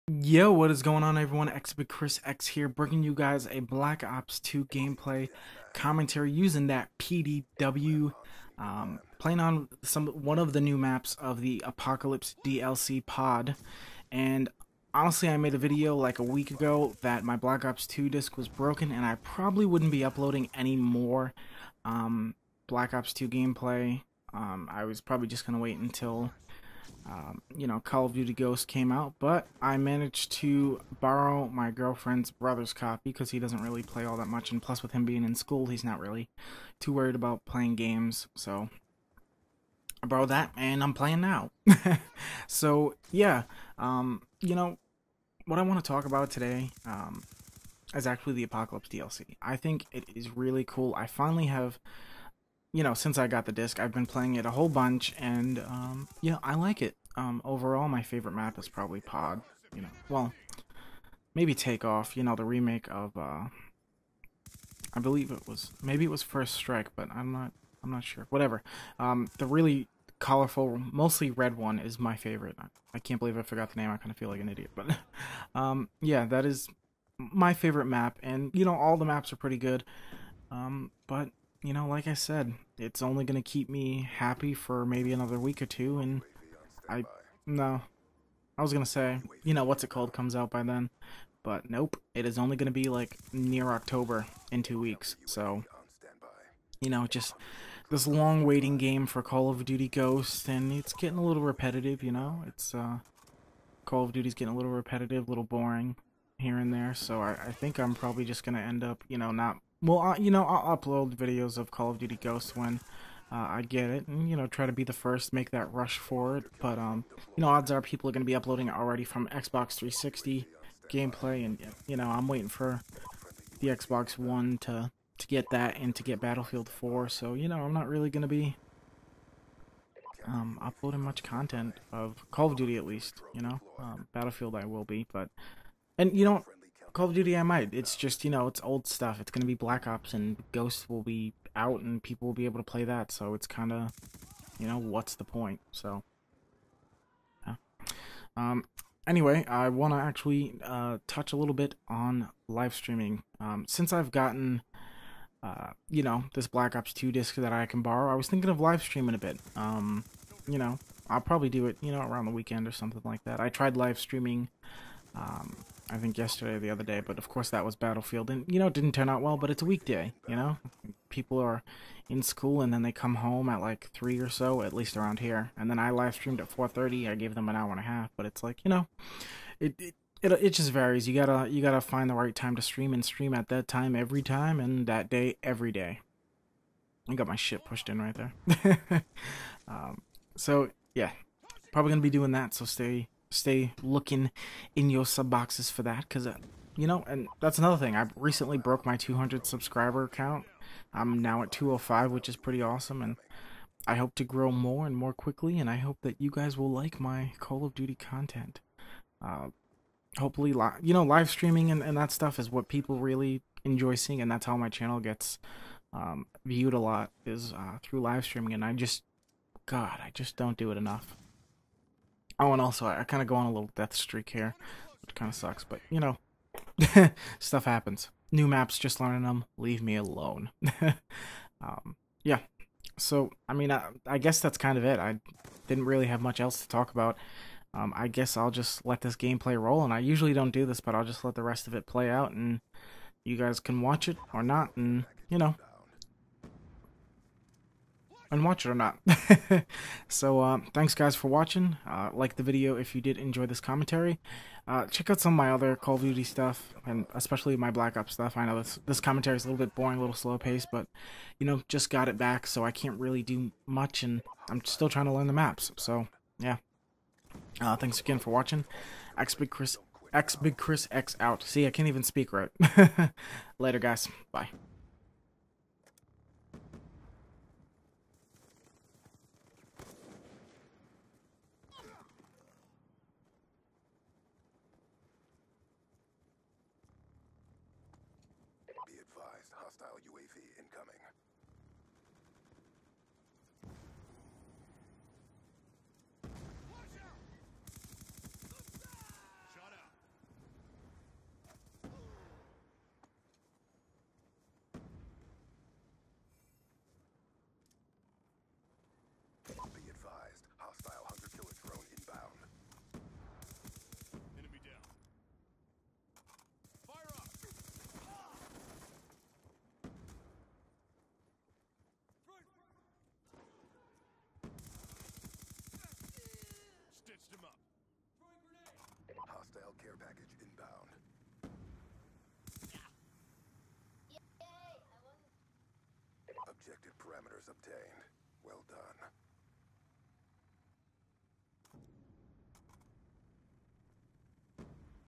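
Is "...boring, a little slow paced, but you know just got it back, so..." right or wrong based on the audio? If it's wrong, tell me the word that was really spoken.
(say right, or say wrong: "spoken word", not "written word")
right.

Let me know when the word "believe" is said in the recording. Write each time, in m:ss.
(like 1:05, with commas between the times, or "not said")
1:05, 1:13.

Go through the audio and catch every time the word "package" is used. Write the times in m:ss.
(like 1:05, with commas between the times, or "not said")
5:29.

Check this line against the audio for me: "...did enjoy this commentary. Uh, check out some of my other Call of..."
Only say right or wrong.
right.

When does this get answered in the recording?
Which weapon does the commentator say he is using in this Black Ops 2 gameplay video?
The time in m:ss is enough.
0:06.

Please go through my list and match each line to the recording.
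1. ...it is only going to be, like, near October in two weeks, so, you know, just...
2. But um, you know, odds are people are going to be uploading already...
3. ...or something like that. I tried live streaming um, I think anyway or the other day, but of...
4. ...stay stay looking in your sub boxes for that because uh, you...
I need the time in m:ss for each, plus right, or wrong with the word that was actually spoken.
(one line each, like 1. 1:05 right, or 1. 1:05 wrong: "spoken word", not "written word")
1. 1:32 right
2. 1:56 right
3. 2:42 wrong: "yesterday", not "anyway"
4. 3:12 right.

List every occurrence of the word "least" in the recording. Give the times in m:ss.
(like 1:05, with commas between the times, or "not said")
2:12, 2:54.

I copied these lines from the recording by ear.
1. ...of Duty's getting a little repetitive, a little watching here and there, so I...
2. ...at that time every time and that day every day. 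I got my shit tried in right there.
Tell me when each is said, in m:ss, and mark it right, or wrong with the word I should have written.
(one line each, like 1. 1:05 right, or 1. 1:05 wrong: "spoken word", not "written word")
1. 1:44 wrong: "boring", not "watching"
2. 3:03 wrong: "pushed", not "tried".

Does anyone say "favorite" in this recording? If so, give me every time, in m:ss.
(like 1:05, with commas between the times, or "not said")
0:58, 1:12, 1:17.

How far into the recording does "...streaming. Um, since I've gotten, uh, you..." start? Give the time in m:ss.
2:32.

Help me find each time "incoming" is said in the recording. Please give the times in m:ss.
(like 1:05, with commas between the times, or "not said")
4:50.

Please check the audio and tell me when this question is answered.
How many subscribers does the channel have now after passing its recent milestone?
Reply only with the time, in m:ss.
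3:21.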